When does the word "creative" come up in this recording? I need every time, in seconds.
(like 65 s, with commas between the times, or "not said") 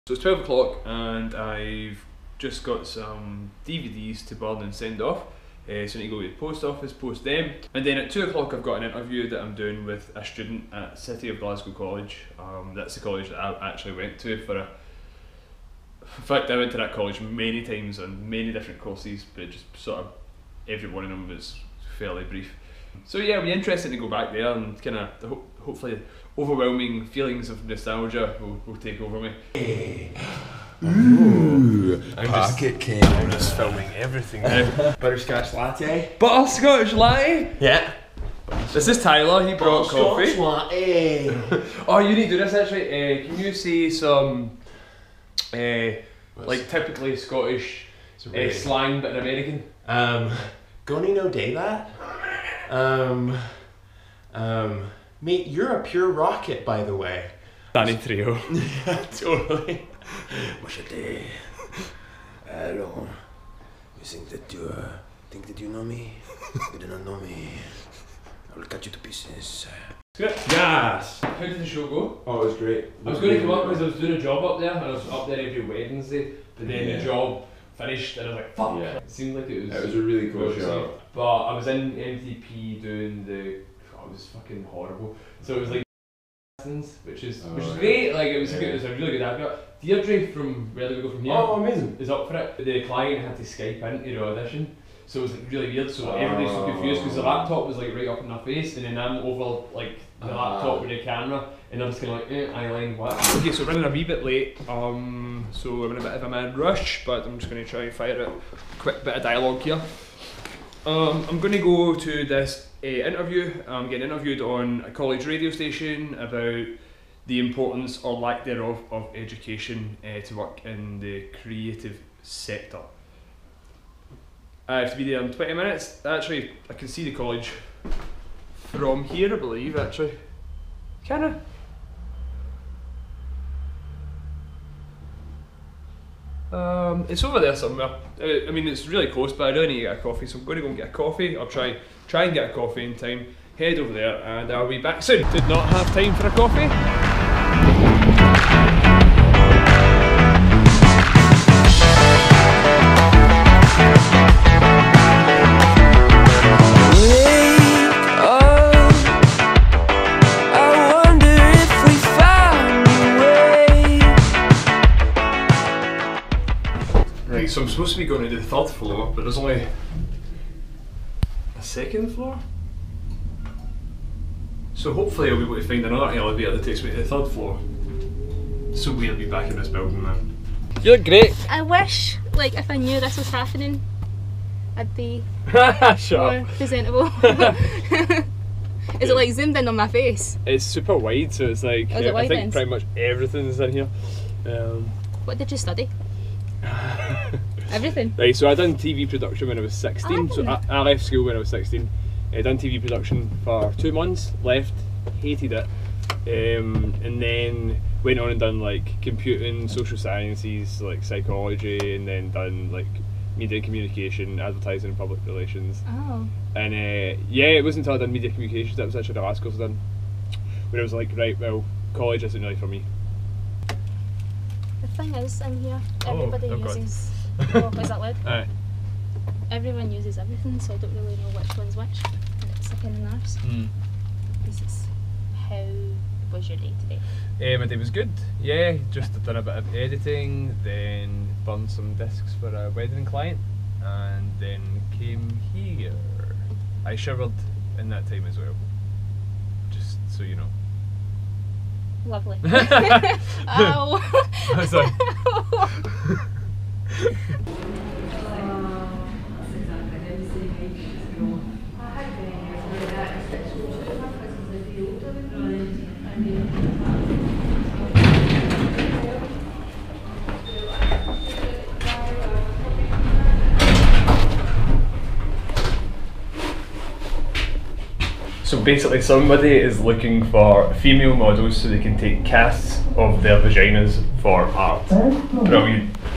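121 s.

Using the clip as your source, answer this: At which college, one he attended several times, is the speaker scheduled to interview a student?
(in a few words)
City of Glasgow College.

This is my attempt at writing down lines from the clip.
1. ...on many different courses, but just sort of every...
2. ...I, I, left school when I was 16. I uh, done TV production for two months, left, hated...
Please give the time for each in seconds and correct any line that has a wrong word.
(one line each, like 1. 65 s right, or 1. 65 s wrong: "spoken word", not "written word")
1. 17 s right
2. 200 s right.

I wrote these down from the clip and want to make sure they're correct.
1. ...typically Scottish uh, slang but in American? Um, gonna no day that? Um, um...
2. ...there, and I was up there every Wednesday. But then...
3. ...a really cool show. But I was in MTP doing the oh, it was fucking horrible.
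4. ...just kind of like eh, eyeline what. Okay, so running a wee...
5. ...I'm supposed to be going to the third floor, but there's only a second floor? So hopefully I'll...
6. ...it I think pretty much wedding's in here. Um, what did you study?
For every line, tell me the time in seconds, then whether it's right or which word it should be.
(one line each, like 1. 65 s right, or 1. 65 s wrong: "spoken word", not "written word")
1. 46 s right
2. 74 s right
3. 79 s right
4. 101 s right
5. 167 s right
6. 192 s wrong: "everything", not "wedding".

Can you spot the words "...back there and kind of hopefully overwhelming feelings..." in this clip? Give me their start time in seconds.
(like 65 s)
24 s.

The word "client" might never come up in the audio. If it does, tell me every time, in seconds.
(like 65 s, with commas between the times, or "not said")
92 s, 243 s.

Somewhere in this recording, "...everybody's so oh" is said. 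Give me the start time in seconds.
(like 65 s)
96 s.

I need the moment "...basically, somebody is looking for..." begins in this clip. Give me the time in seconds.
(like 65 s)
278 s.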